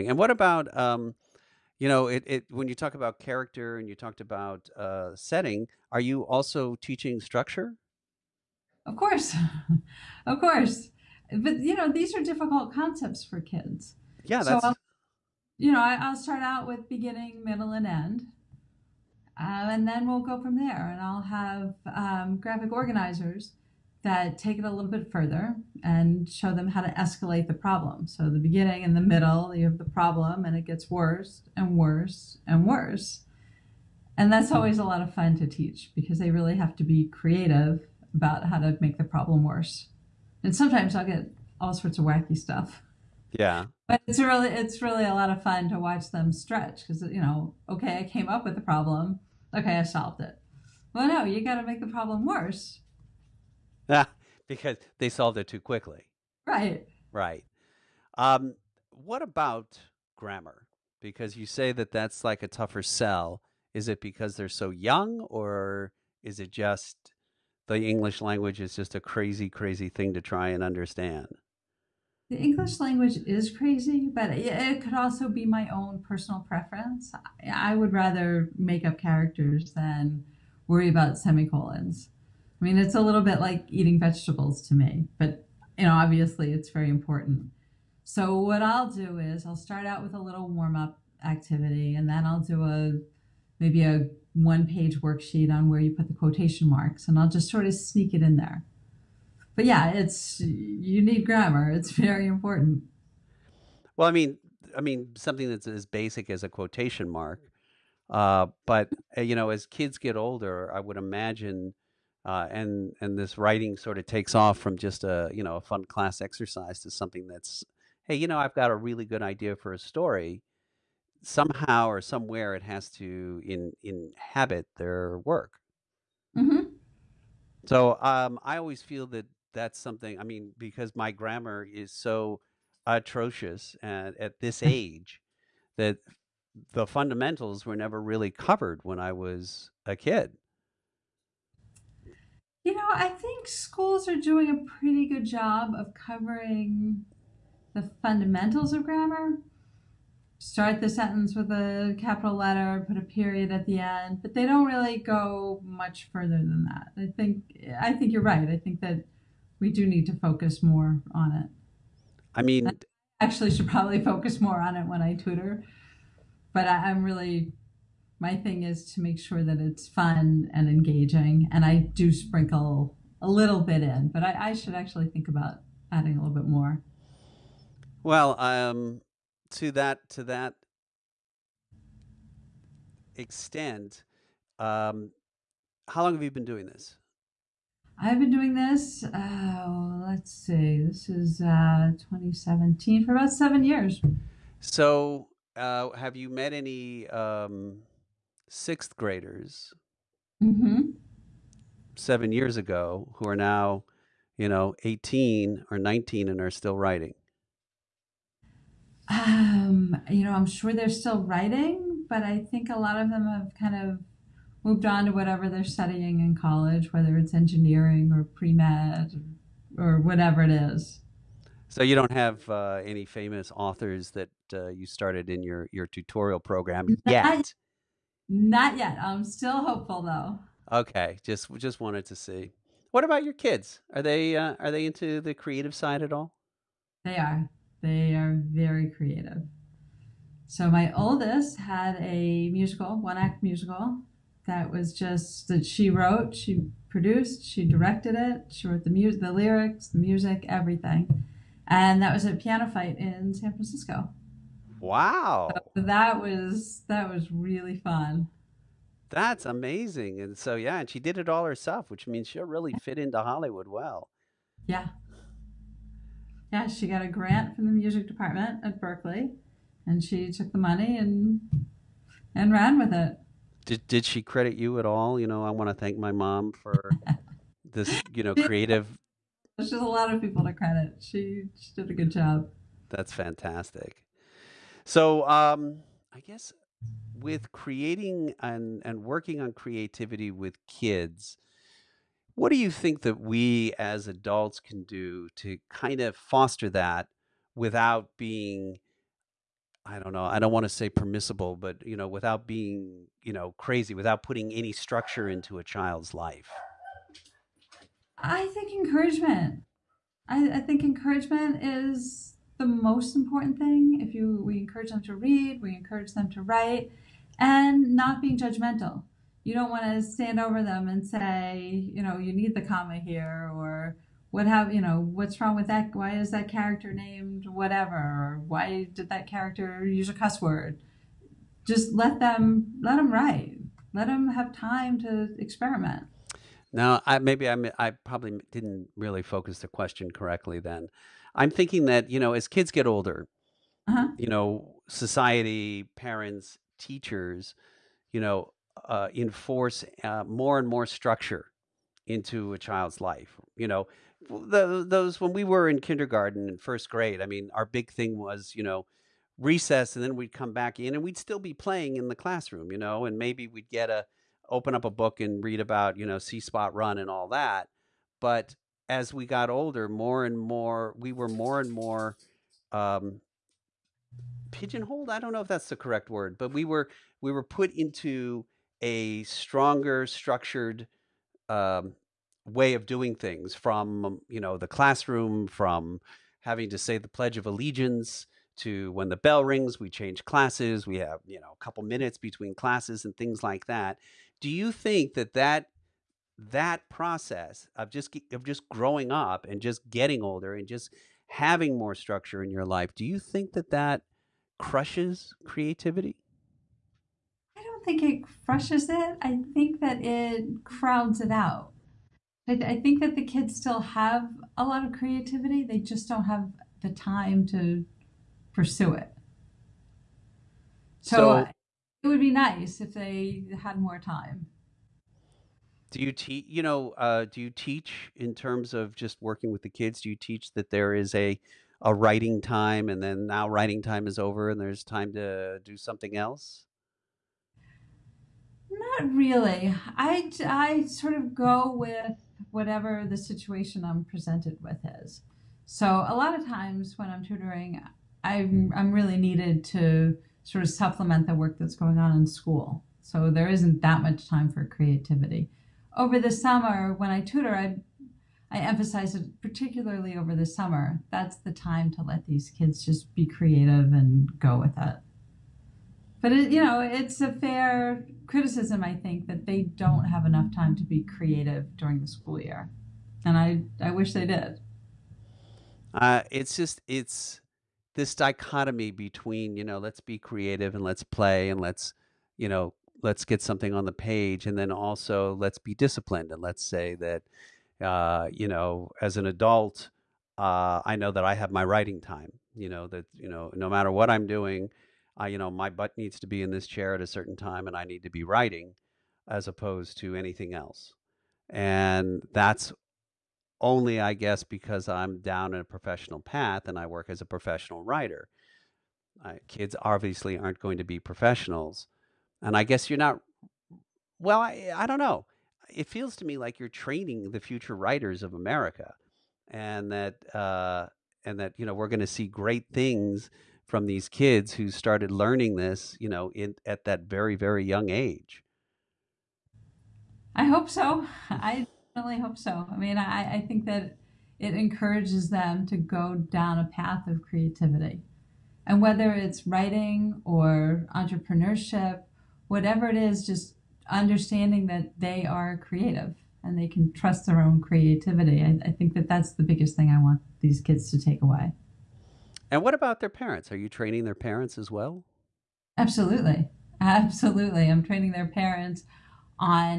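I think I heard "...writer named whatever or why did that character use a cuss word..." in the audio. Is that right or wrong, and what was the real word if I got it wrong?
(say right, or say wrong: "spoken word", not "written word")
wrong: "character", not "writer".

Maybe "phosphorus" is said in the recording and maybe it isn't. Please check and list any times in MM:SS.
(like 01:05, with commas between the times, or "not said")
not said.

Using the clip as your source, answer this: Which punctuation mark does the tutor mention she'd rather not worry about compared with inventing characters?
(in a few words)
semicolons.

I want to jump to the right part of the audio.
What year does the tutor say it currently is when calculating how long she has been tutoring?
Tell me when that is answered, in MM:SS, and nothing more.
03:11.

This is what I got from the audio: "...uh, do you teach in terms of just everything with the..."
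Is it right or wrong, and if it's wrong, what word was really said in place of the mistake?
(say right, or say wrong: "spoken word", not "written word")
wrong: "working", not "everything".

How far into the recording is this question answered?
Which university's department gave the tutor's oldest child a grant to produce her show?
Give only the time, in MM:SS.
04:28.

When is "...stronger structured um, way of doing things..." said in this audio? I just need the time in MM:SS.
06:19.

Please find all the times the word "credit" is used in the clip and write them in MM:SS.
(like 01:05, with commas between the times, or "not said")
04:34, 04:40.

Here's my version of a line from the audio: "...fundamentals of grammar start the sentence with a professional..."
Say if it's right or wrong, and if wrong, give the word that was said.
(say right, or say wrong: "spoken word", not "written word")
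wrong: "capital", not "professional".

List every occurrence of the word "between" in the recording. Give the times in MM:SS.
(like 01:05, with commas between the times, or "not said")
06:32, 07:58.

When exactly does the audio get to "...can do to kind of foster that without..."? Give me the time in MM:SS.
04:54.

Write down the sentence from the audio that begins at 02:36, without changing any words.
I think I think you're right.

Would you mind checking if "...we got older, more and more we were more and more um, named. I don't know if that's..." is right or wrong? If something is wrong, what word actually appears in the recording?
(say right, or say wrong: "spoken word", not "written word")
wrong: "pigeonholed", not "named".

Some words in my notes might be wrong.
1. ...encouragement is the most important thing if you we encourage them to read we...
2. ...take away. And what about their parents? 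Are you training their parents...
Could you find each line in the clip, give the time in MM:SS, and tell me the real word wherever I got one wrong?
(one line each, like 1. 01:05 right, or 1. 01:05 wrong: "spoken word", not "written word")
1. 05:10 right
2. 09:11 right.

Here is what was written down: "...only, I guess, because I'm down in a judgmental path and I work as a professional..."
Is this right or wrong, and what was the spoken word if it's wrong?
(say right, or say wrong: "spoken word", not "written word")
wrong: "professional", not "judgmental".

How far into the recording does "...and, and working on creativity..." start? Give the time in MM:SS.
04:48.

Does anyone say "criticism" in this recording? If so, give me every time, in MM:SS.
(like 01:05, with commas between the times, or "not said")
07:48.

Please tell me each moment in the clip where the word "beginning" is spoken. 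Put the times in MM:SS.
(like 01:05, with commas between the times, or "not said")
00:16, 00:28.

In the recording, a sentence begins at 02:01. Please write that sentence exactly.
Somehow or somewhere, it has to in inhabit their work.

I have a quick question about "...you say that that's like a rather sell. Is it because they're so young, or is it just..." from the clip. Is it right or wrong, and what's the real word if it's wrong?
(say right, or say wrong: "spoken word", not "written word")
wrong: "tougher", not "rather".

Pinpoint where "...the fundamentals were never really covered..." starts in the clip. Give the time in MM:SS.
02:16.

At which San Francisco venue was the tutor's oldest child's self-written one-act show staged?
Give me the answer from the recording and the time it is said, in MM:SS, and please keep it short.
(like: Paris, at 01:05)
PianoFight, at 04:12.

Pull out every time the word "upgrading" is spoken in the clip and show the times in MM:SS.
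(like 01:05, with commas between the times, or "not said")
not said.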